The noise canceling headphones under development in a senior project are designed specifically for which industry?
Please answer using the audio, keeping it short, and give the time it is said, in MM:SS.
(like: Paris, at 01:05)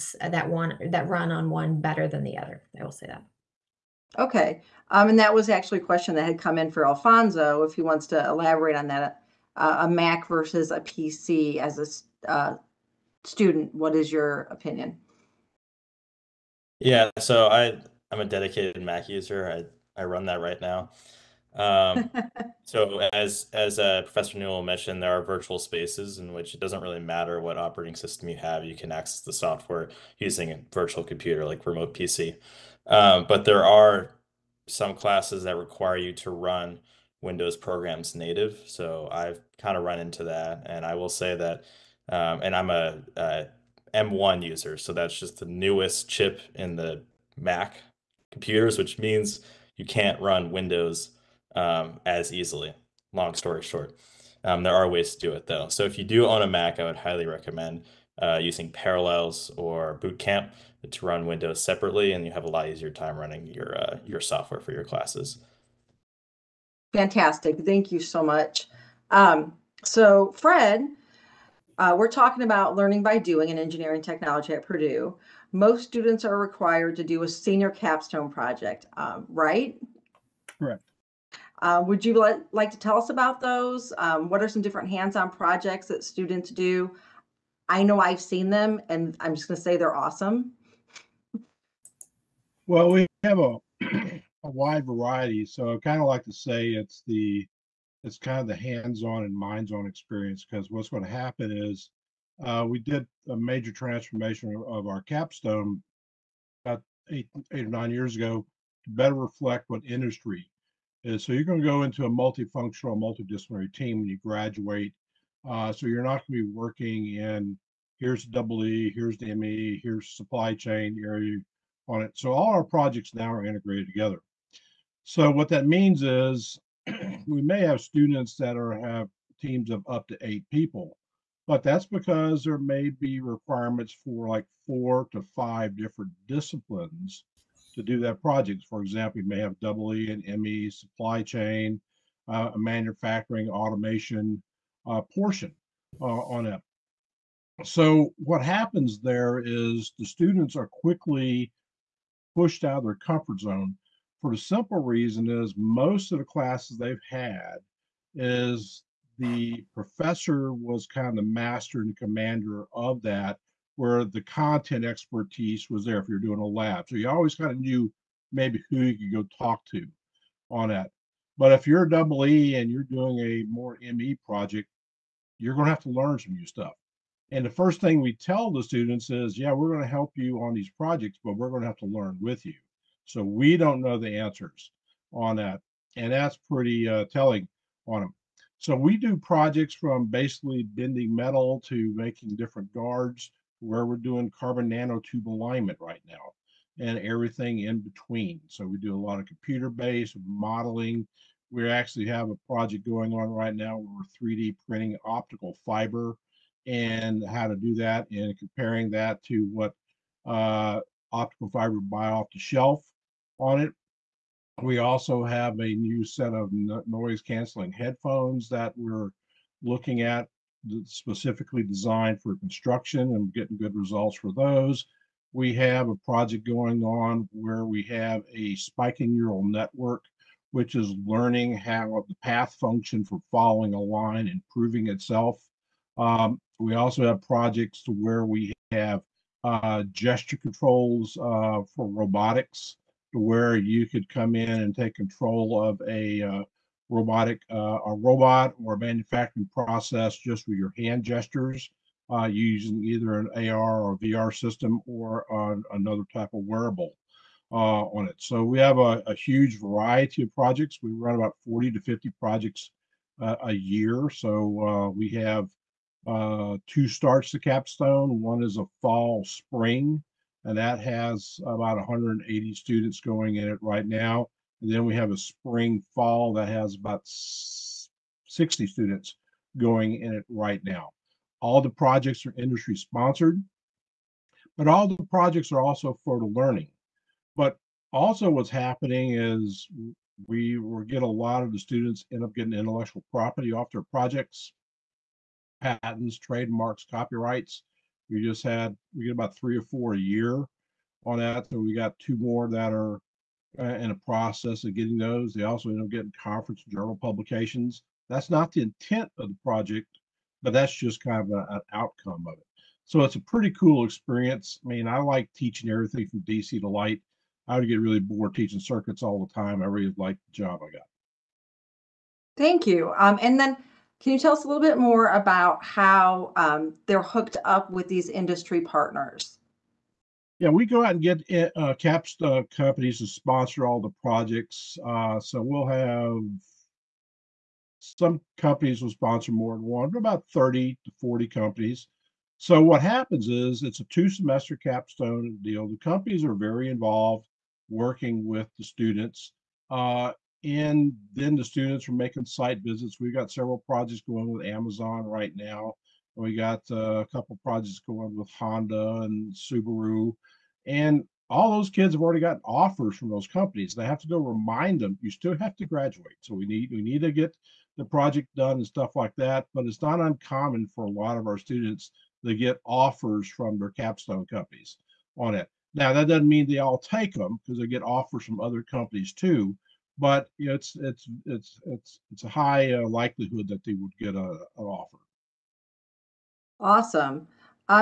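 Construction, at 03:42.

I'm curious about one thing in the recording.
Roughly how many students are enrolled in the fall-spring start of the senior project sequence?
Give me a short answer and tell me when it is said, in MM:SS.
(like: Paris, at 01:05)
180, at 04:31.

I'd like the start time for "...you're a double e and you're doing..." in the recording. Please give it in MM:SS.
02:51.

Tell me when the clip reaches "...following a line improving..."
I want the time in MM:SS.
03:53.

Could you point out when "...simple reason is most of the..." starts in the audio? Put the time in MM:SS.
02:34.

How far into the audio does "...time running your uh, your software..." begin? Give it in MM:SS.
01:02.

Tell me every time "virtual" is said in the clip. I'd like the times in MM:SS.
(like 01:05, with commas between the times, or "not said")
00:25, 00:30.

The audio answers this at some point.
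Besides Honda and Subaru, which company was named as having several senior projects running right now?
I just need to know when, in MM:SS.
05:54.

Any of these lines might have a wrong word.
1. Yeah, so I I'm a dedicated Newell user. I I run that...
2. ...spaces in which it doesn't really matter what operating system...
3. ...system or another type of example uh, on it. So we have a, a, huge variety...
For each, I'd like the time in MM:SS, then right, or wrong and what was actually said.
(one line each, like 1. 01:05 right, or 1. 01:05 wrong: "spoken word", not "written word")
1. 00:16 wrong: "Mac", not "Newell"
2. 00:25 right
3. 04:14 wrong: "wearable", not "example".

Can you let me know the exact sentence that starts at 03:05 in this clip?
And that's pretty uh, telling on them.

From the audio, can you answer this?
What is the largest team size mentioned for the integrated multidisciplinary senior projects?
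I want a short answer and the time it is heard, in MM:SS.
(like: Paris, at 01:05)
8, at 02:10.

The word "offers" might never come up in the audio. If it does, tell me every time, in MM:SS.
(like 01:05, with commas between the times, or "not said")
06:02, 06:12, 06:17, 06:24.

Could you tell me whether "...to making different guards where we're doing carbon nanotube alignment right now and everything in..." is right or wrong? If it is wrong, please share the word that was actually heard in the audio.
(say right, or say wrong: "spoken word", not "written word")
right.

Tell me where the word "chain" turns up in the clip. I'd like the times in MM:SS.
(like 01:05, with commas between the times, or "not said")
02:00, 02:21.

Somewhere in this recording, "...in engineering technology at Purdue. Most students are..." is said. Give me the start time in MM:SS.
01:13.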